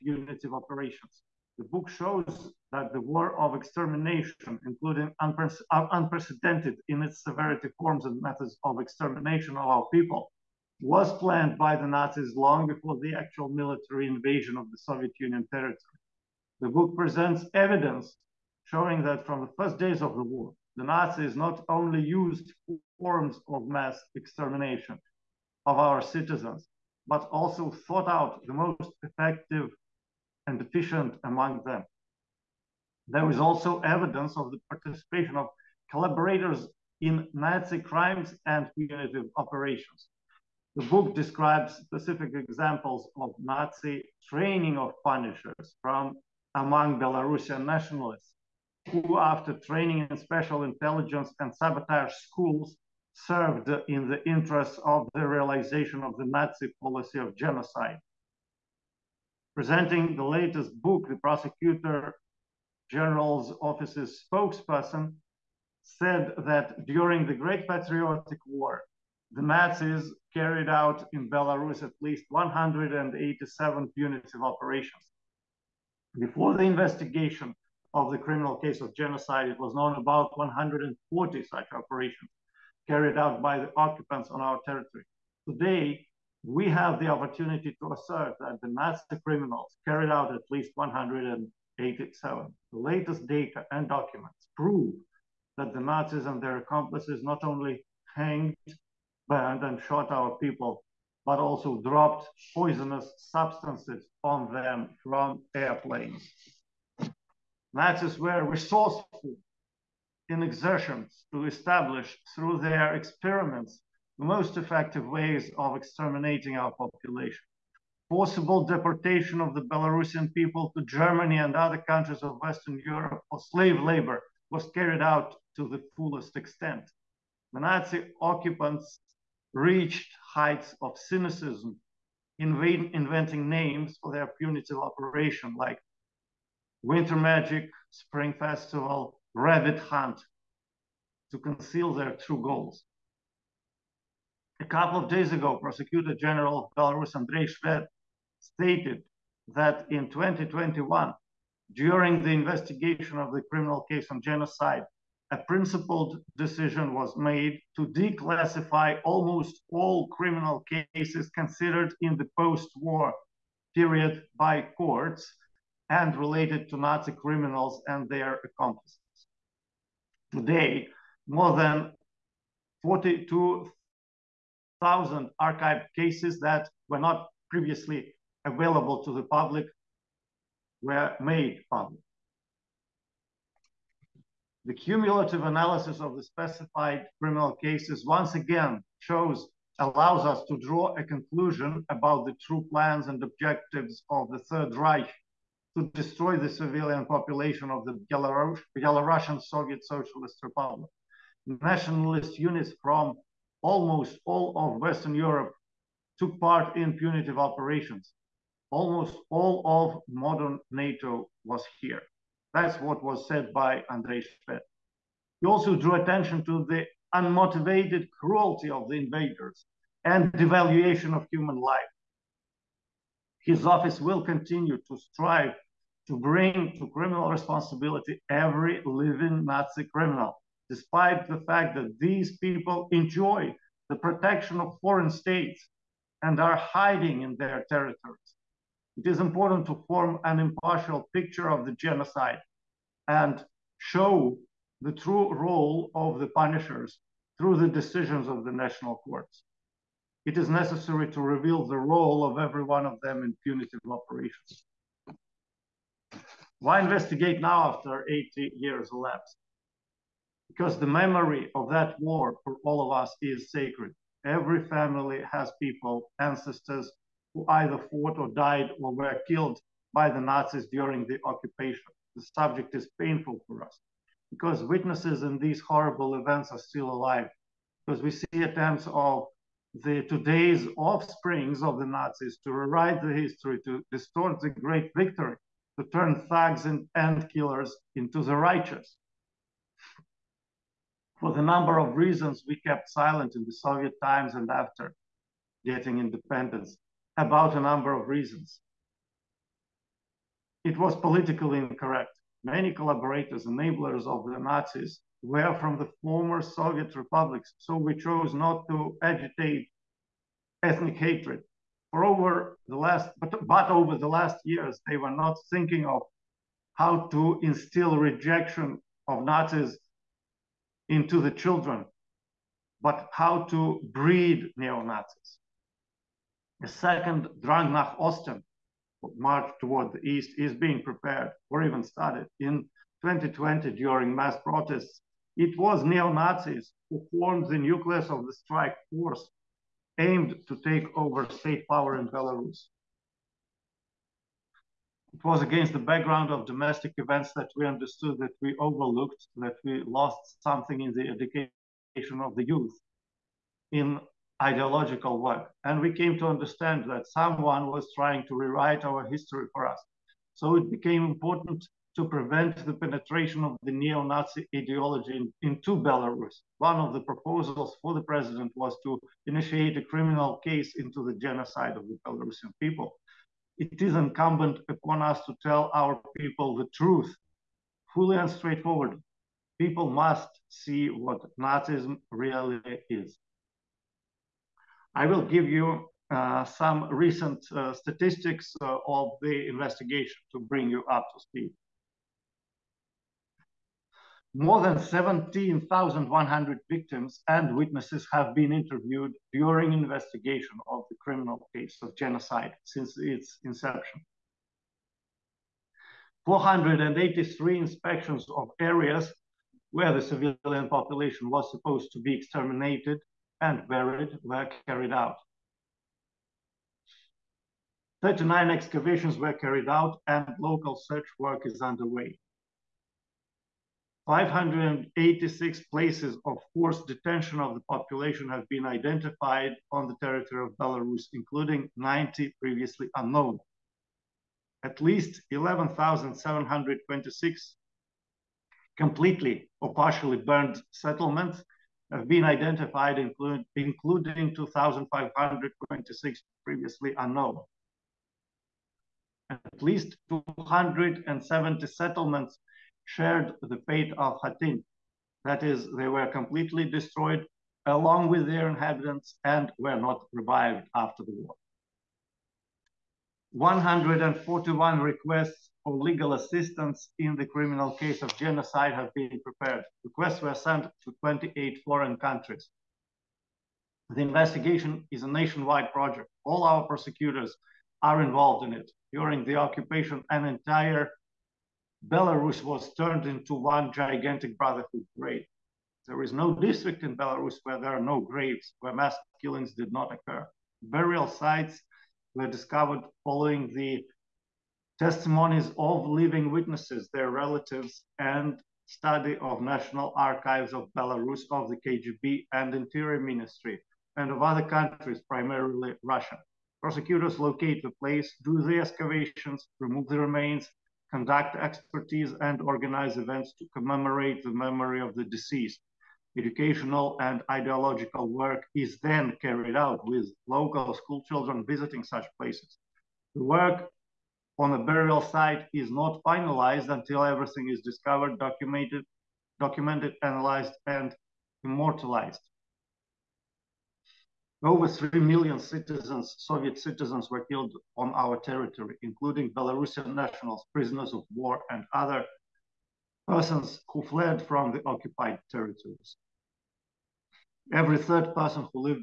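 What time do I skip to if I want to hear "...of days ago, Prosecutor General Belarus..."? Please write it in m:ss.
2:25.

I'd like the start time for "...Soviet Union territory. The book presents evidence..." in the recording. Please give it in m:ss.
0:14.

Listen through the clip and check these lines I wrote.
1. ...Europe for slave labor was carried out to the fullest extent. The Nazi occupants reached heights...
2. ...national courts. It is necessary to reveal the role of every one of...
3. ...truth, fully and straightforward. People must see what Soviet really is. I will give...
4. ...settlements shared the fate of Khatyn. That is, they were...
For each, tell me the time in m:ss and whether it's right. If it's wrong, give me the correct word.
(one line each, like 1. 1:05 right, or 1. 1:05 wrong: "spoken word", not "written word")
1. 2:02 right
2. 4:08 right
3. 6:16 wrong: "Nazism", not "Soviet"
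4. 7:31 right.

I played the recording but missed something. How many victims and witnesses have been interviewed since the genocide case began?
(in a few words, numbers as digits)
17,100.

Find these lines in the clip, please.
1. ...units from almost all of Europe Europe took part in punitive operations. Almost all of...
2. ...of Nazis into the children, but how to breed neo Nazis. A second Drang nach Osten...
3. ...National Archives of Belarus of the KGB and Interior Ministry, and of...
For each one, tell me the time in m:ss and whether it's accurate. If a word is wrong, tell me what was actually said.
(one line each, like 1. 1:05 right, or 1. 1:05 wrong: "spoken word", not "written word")
1. 3:22 wrong: "Western", not "Europe"
2. 5:19 right
3. 8:19 right.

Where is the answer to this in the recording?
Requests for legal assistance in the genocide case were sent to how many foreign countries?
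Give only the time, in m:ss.
7:51.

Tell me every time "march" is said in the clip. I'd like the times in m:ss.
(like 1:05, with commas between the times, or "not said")
5:29.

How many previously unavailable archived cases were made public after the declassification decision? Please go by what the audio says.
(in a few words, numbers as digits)
42,000.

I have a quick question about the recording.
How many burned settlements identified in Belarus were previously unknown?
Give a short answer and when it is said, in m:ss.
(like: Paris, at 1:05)
2,526, at 7:24.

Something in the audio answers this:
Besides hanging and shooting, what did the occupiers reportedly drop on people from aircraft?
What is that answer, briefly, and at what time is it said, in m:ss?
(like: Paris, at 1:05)
poisonous substances, at 1:42.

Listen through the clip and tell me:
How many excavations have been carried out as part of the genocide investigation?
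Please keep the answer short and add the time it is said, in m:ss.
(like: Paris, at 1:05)
39, at 6:58.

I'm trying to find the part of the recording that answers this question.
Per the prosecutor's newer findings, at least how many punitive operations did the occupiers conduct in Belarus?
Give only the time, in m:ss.
1:11.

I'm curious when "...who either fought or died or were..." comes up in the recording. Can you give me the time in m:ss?
4:27.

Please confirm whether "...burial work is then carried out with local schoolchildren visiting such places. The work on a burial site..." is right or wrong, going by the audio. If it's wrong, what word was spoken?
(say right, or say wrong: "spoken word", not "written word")
wrong: "ideological", not "burial".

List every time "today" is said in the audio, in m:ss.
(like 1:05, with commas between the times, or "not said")
1:25, 2:50, 4:40.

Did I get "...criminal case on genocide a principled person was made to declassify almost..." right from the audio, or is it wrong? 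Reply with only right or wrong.
wrong.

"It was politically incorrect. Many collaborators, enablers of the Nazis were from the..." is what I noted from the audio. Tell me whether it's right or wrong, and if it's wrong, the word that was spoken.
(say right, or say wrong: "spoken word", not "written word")
right.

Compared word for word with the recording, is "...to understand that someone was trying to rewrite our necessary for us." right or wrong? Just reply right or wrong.
wrong.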